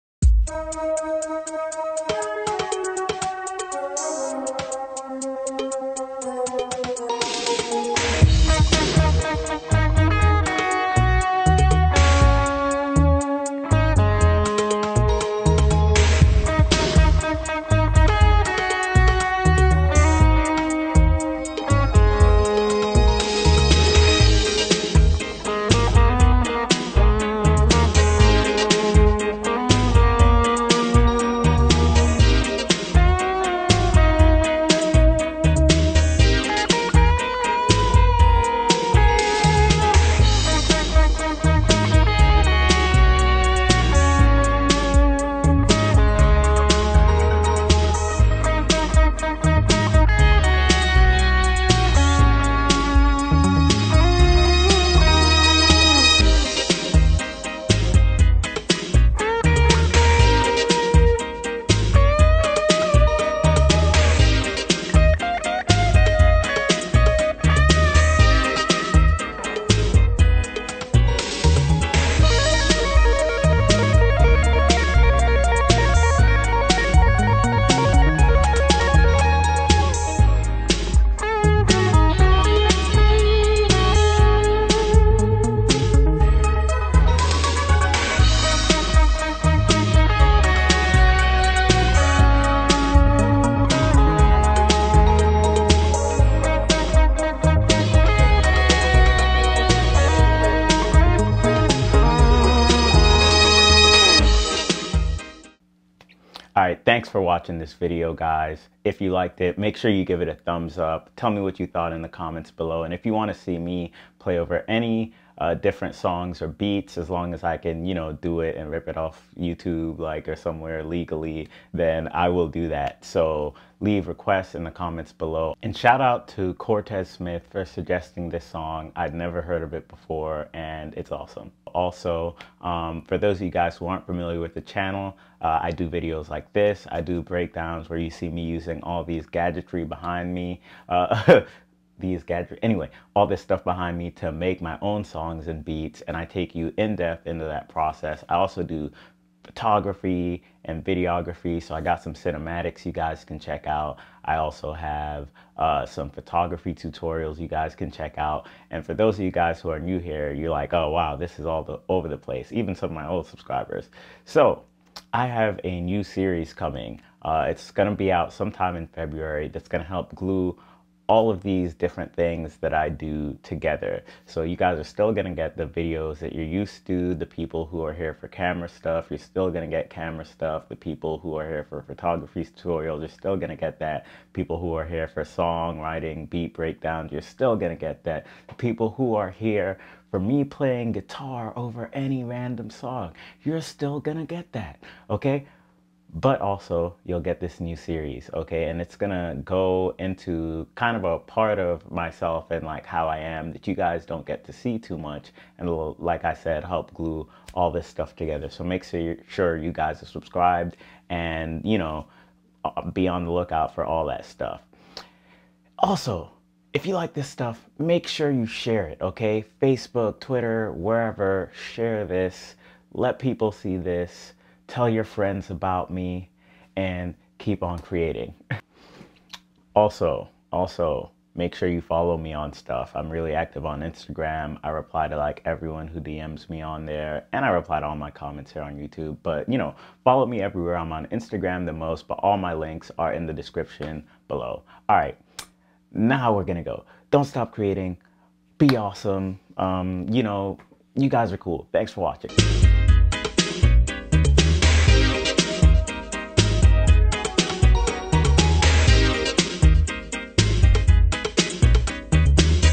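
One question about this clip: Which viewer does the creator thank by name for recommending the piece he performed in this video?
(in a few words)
Cortez Smith.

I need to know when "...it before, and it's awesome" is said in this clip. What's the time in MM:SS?
02:09.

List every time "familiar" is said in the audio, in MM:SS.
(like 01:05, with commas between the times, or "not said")
02:14.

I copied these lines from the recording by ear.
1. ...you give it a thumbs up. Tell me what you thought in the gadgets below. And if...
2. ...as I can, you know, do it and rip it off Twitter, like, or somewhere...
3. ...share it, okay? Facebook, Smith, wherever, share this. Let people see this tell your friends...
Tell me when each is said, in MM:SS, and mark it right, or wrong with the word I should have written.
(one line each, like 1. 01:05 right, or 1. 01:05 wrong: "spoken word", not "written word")
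1. 01:49 wrong: "comments", not "gadgets"
2. 01:57 wrong: "YouTube", not "Twitter"
3. 03:38 wrong: "Twitter", not "Smith".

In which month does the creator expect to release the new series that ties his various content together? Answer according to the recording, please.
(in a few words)
February.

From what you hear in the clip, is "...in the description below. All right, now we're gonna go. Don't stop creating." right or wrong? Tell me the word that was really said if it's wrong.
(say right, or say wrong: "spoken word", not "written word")
right.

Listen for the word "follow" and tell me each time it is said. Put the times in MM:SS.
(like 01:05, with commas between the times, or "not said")
03:51, 04:00.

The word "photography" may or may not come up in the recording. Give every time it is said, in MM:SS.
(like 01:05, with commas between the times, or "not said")
02:29, 02:36, 03:01.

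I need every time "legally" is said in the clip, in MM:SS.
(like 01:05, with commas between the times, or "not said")
02:00.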